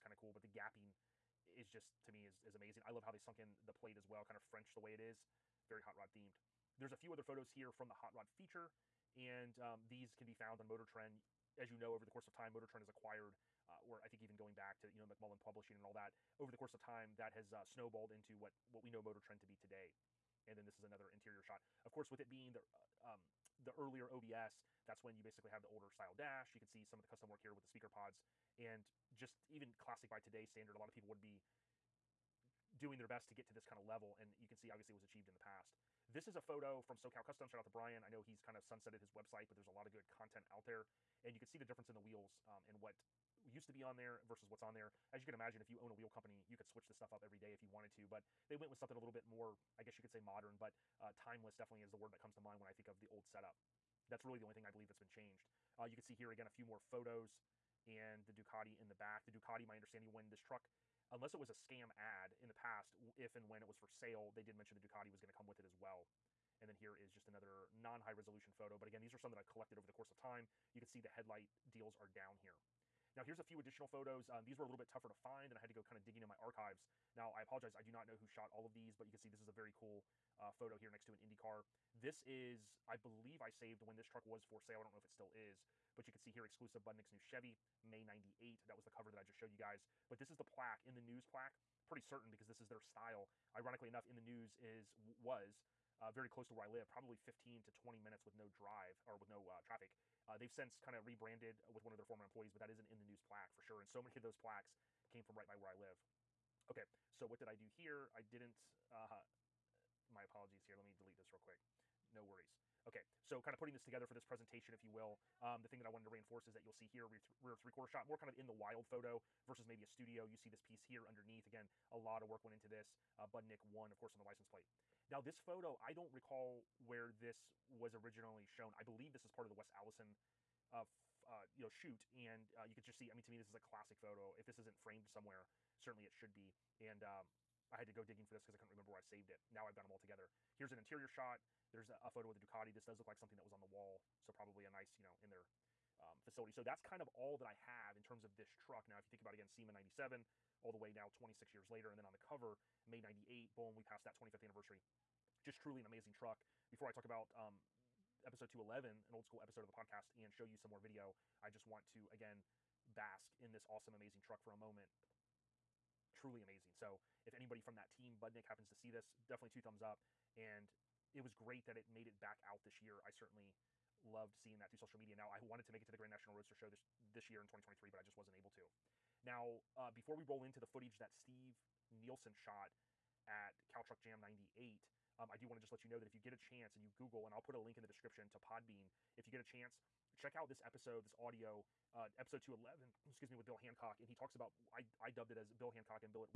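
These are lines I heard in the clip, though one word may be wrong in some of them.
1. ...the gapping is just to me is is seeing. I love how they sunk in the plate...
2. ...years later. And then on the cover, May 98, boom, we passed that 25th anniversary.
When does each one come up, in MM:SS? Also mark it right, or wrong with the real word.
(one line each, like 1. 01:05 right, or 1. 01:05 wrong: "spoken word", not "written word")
1. 00:00 wrong: "amazing", not "seeing"
2. 02:31 right.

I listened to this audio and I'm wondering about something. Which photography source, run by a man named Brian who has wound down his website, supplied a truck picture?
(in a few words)
SoCal Custom.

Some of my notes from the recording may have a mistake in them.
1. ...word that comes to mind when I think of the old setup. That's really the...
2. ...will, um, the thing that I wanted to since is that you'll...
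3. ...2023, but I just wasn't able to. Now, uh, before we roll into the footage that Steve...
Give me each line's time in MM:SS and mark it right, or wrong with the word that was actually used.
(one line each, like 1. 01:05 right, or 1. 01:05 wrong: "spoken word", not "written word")
1. 00:51 right
2. 01:54 wrong: "reinforce", not "since"
3. 02:57 right.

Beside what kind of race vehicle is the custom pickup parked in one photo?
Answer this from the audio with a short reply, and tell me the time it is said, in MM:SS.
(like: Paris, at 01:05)
Indy car, at 01:21.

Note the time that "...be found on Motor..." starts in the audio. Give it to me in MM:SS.
00:10.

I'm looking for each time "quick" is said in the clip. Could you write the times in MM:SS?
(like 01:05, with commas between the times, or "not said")
01:51.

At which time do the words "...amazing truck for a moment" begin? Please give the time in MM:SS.
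02:43.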